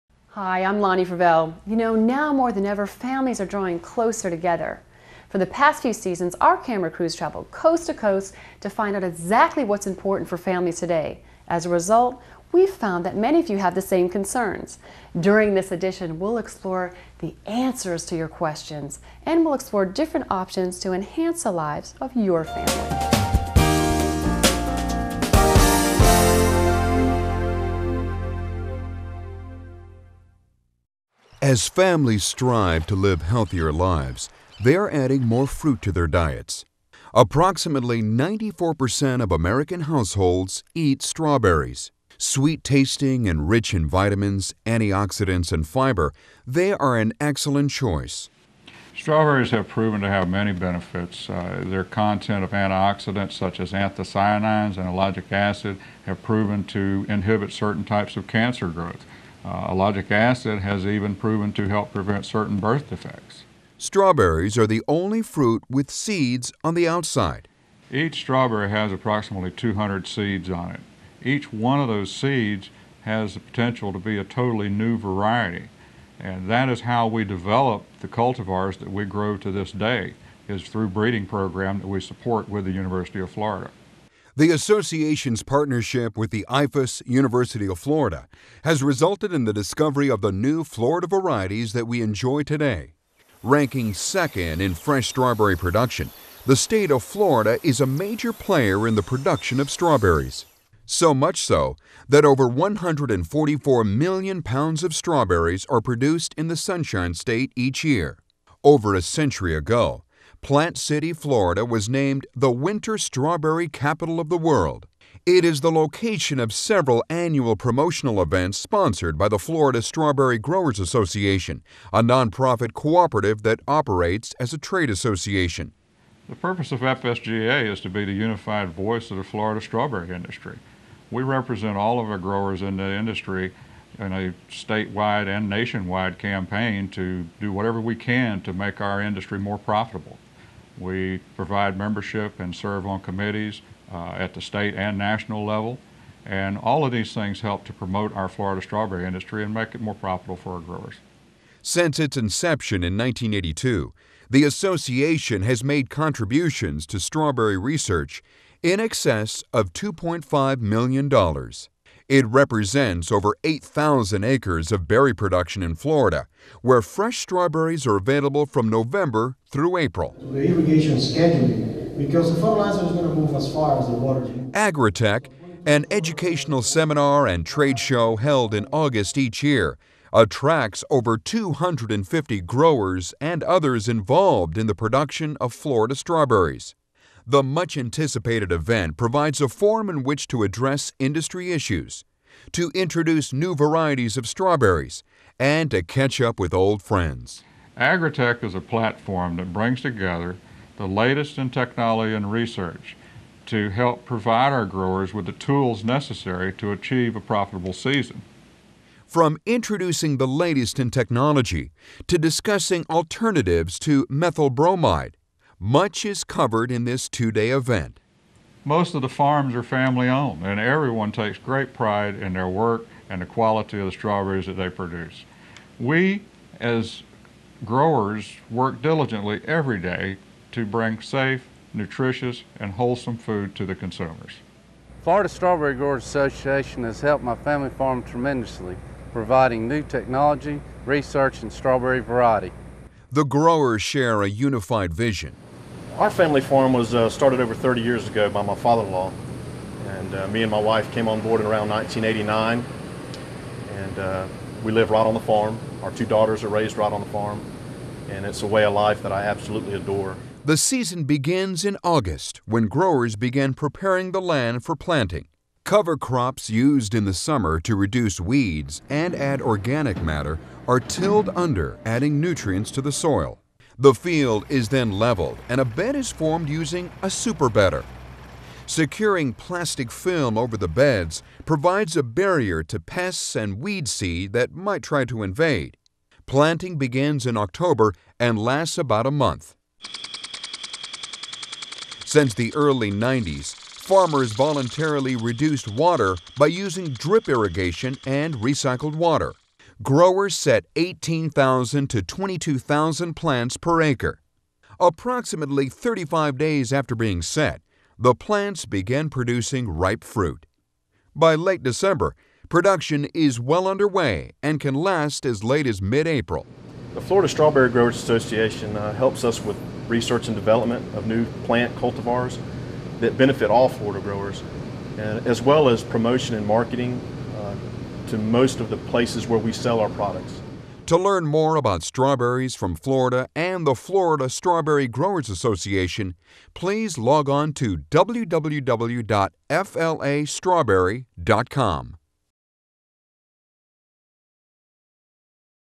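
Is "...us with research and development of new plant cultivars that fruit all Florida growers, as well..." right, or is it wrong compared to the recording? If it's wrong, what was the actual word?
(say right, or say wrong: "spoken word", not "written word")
wrong: "benefit", not "fruit".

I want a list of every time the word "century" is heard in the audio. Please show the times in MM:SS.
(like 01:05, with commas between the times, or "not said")
01:49.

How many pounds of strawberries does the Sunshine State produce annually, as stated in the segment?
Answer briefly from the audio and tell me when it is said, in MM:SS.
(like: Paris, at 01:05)
144 million, at 01:42.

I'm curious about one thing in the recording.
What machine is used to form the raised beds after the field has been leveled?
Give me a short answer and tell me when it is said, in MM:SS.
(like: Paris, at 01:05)
superbedder, at 04:37.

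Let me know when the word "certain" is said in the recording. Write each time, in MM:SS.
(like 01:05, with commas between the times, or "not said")
00:57, 01:02.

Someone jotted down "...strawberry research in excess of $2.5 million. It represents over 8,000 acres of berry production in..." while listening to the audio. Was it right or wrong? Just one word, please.
right.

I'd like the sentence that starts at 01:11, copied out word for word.
Each one of those seeds has the potential to be a totally new variety.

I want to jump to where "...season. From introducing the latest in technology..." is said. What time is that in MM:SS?
03:27.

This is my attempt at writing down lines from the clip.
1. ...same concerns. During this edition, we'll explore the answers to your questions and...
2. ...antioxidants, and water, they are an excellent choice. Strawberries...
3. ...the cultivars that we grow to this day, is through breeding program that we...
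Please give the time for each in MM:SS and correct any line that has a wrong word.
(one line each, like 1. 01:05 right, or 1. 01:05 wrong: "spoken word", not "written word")
1. 00:13 right
2. 00:44 wrong: "fiber", not "water"
3. 01:17 right.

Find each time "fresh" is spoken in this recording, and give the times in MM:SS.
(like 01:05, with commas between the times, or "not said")
01:34, 02:46.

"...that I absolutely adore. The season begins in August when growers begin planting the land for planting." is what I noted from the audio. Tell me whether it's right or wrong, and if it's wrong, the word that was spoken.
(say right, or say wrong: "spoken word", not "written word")
wrong: "preparing", not "planting".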